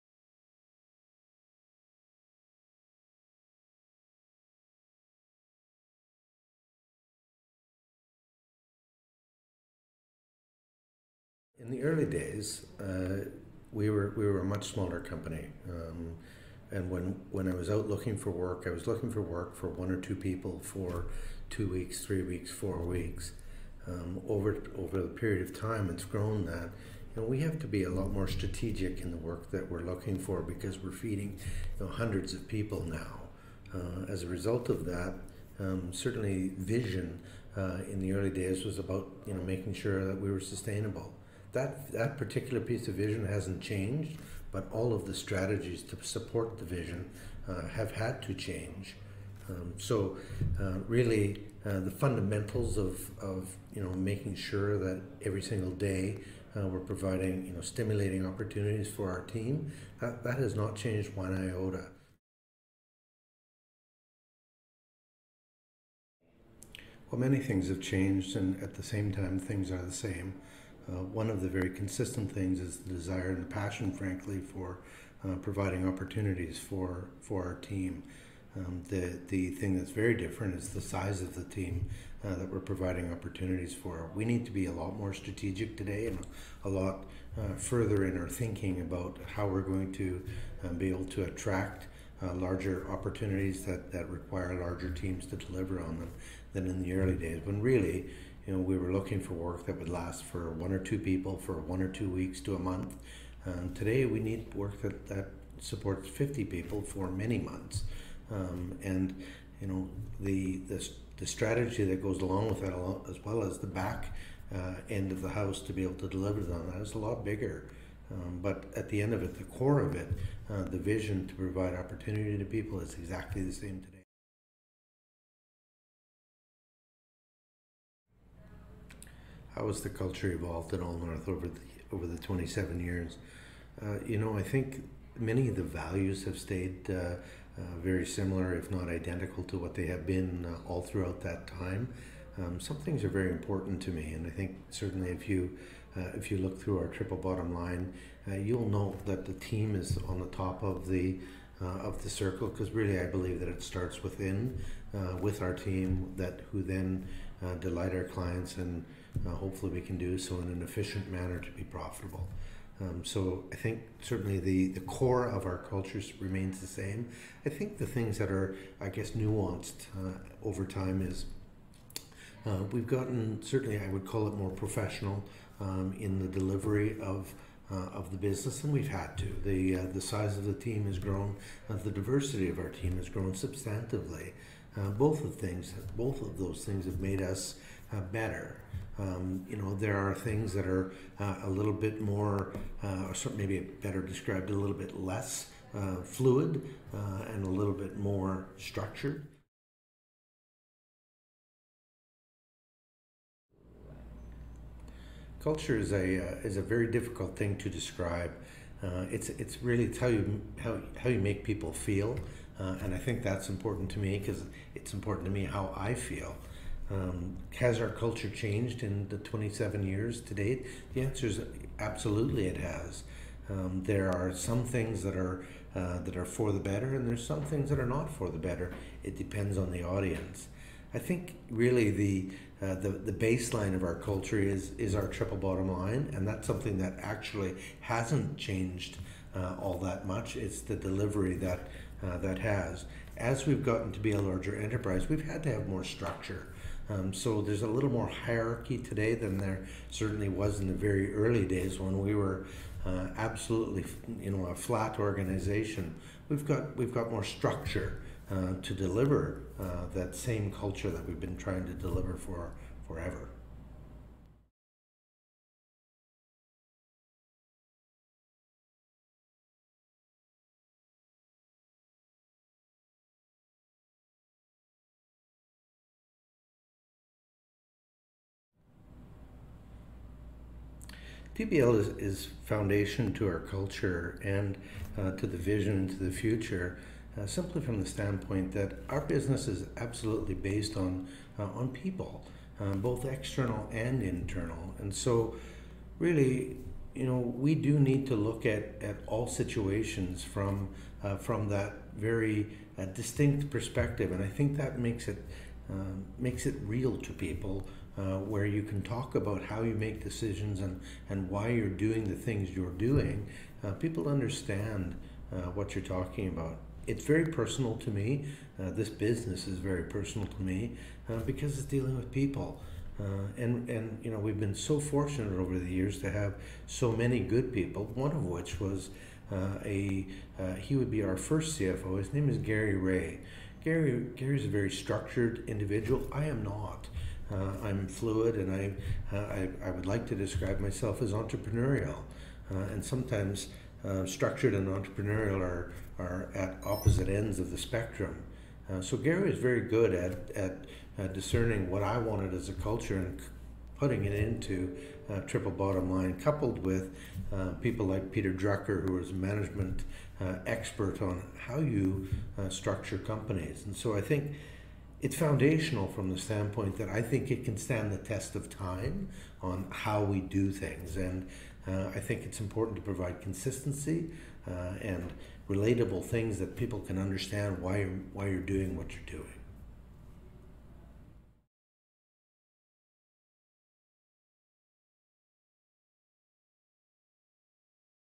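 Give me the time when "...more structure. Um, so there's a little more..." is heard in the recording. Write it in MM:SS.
04:05.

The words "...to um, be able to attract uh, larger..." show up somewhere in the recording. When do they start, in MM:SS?
01:29.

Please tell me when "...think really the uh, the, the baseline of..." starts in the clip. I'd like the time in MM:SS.
03:50.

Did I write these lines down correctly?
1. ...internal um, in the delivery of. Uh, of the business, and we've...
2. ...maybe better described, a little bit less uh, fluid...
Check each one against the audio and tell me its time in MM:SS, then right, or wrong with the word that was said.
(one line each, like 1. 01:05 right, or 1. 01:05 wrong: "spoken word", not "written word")
1. 02:54 wrong: "professional", not "internal"
2. 03:13 right.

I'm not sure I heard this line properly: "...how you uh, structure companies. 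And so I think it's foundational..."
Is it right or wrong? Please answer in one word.
right.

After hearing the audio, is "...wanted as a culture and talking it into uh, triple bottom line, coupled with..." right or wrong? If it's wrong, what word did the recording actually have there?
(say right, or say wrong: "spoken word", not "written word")
wrong: "putting", not "talking".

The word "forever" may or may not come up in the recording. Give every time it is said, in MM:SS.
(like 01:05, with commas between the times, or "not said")
04:22.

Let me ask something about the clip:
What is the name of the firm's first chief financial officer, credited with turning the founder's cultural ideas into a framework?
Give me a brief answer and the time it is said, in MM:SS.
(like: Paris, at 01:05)
Gary Ray, at 05:32.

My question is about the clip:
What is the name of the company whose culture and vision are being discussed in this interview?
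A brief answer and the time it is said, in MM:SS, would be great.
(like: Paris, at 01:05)
Allnorth, at 02:10.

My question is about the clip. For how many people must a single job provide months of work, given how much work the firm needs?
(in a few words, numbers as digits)
50.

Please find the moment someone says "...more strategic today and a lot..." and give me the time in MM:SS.
01:24.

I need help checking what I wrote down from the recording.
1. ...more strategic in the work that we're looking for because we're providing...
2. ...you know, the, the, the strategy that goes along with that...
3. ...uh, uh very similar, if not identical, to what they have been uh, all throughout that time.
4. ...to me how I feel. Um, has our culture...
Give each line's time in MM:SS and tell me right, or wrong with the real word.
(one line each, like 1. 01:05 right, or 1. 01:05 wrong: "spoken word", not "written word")
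1. 00:28 wrong: "feeding", not "providing"
2. 01:49 right
3. 02:16 right
4. 03:35 right.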